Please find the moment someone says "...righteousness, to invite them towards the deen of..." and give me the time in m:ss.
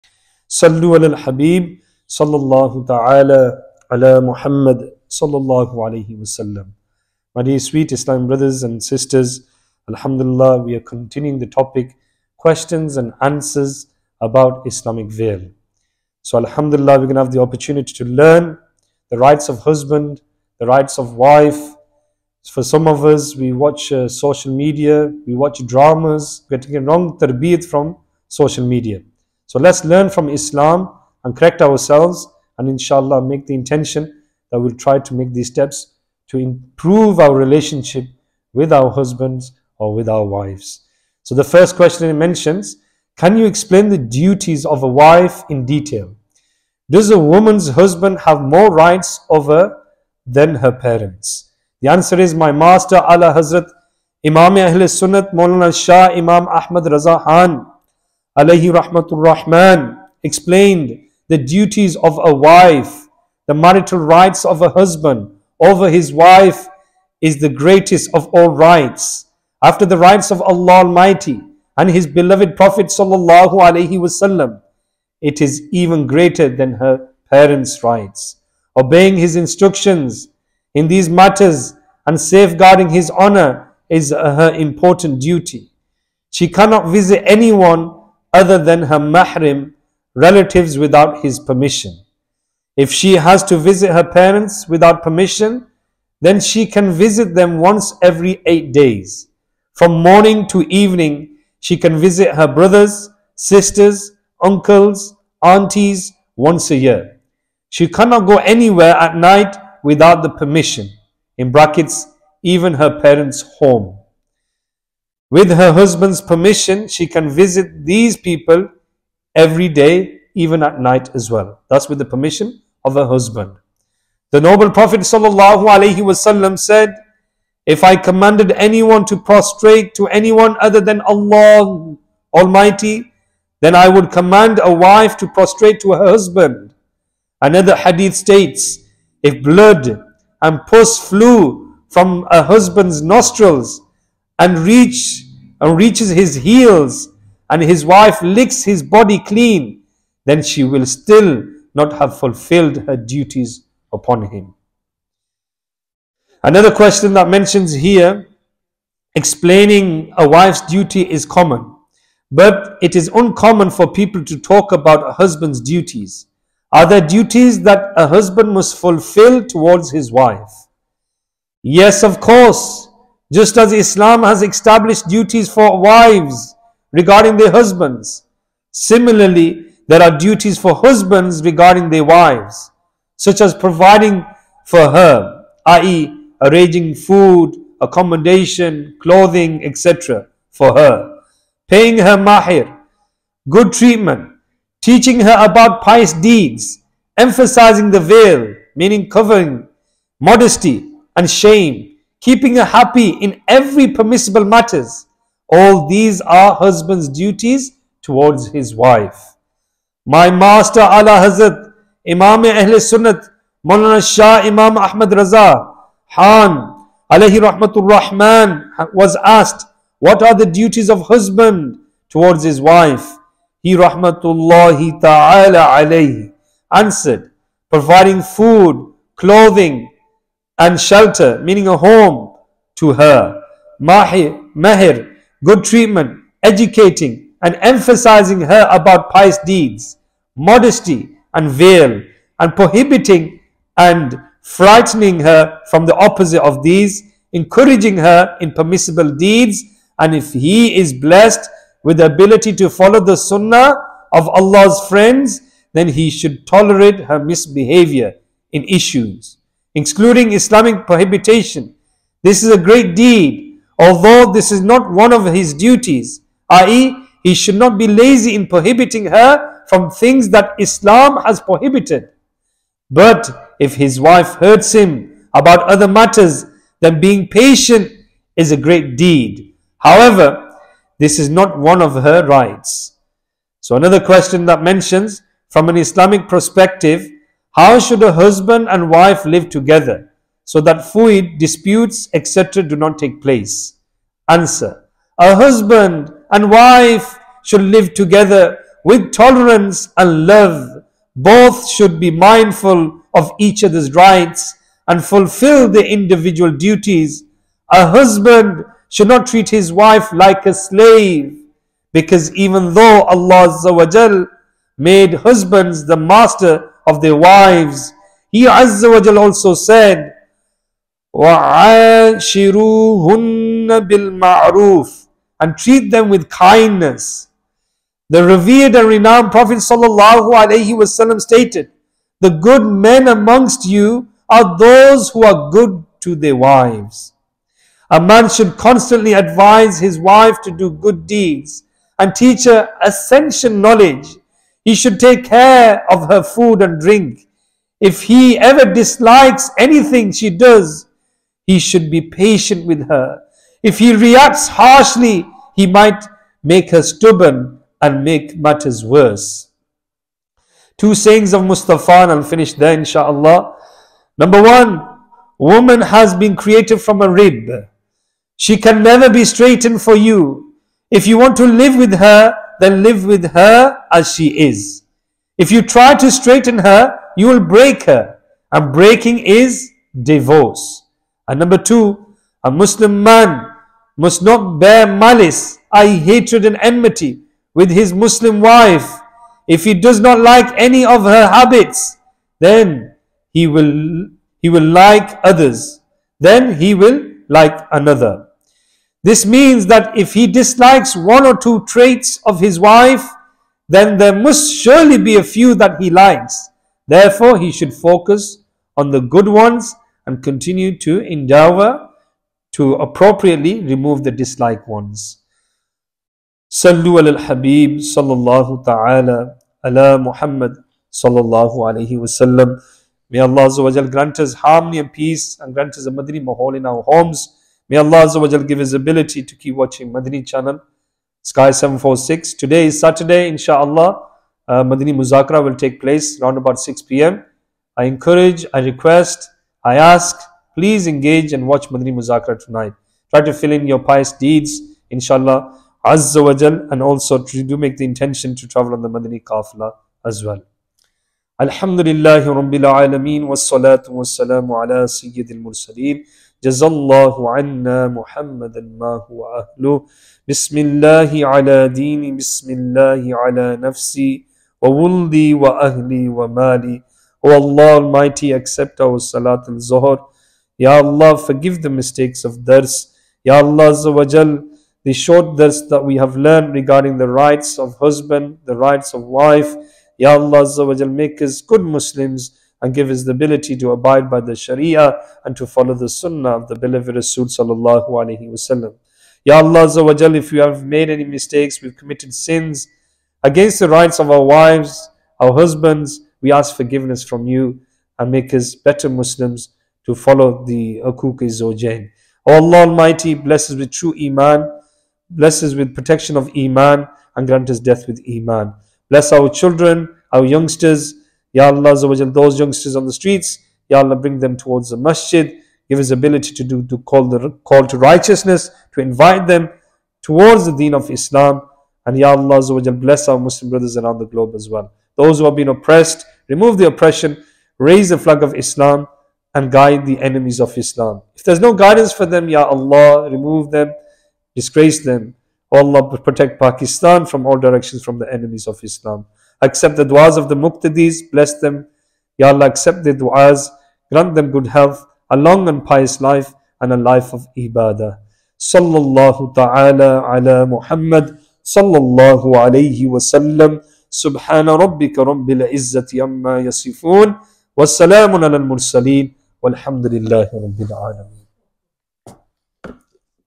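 8:37.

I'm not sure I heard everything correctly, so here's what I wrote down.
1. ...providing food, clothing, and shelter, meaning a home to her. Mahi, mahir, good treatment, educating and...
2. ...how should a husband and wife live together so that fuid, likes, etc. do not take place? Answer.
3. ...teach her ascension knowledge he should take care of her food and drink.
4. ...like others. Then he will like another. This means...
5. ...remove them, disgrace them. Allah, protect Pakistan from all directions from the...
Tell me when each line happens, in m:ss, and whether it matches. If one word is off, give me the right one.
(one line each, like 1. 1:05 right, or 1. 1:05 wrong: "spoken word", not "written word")
1. 3:47 right
2. 4:47 wrong: "disputes", not "likes"
3. 5:42 right
4. 6:34 right
5. 8:53 right.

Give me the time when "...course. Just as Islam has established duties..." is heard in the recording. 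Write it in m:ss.
2:52.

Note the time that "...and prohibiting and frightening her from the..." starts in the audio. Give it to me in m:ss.
4:02.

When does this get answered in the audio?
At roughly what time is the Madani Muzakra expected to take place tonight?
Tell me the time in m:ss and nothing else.
7:16.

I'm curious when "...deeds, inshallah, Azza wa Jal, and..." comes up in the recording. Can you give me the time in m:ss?
7:24.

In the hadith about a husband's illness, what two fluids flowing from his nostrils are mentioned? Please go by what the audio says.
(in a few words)
Blood and pus.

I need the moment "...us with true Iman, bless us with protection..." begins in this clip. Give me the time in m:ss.
8:23.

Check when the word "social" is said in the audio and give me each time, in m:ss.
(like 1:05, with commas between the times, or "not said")
0:24, 0:28.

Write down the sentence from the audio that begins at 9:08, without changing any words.
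Sallallahu ta'ala ala Muhammad, sallallahu alayhi wa sallam.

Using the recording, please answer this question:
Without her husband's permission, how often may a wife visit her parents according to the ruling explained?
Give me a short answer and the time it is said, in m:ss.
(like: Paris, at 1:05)
Once every 8 days, at 1:37.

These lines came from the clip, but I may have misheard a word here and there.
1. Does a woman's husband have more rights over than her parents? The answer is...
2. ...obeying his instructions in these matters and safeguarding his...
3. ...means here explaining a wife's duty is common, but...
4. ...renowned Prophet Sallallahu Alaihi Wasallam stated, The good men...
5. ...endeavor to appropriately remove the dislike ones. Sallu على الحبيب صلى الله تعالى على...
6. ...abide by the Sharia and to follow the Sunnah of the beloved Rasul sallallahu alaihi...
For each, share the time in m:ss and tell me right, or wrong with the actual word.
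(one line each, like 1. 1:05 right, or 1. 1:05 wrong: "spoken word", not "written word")
1. 0:46 right
2. 1:18 right
3. 2:37 wrong: "mentions", not "means"
4. 5:28 right
5. 6:50 right
6. 8:03 right.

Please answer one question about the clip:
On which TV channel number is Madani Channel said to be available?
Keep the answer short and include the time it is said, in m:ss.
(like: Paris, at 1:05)
Sky 746, at 7:11.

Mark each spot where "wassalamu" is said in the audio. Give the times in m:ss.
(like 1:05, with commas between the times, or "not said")
7:33.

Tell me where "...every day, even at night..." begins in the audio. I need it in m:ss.
1:59.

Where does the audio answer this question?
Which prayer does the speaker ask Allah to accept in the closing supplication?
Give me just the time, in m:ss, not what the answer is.
7:48.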